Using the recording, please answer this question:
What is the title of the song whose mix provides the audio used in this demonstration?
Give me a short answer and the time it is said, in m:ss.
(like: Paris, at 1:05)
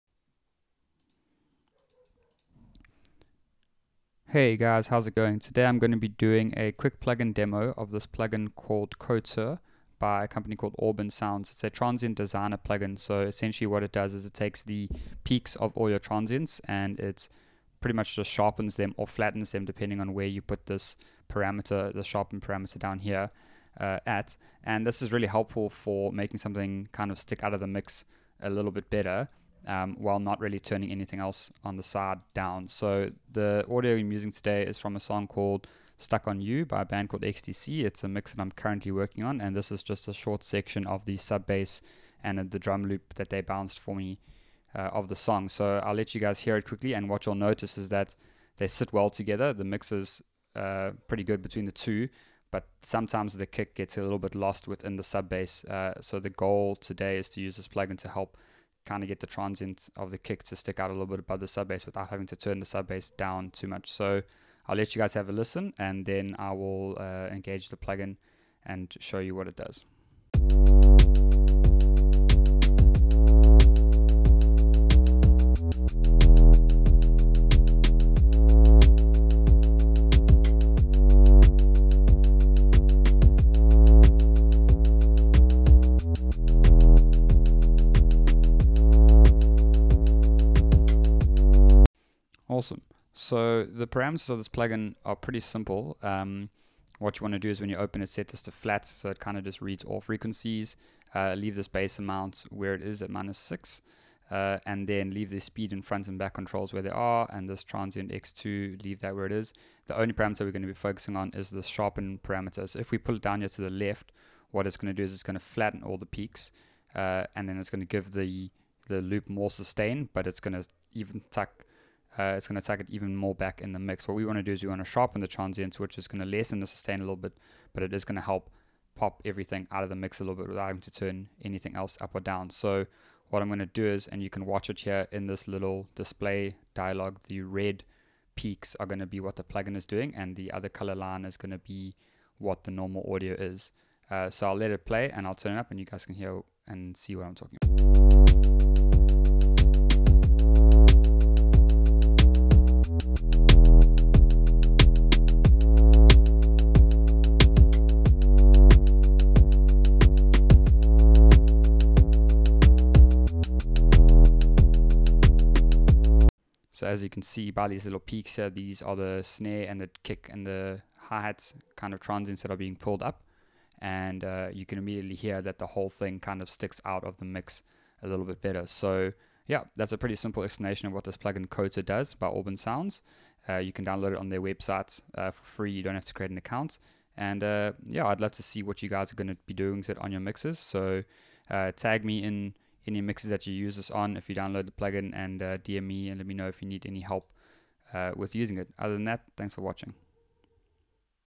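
Stuck on You, at 0:35.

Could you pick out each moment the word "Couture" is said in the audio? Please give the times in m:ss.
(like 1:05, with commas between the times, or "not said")
0:08, 3:01.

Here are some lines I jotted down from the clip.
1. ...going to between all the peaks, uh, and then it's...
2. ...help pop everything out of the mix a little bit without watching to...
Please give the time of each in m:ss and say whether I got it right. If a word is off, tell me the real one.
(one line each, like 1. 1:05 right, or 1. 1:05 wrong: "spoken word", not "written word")
1. 1:55 wrong: "flatten", not "between"
2. 2:08 wrong: "having", not "watching".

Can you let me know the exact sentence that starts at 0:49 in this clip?
The mix is uh, pretty good between the two, but sometimes the kick gets a little bit lost within the sub bass.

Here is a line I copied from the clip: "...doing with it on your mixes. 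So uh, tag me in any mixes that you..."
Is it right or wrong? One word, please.
right.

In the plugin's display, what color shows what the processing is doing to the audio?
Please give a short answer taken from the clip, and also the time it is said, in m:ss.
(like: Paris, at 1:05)
Red, at 2:17.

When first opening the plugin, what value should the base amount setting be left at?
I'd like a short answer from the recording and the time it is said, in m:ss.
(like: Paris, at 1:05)
-6, at 1:43.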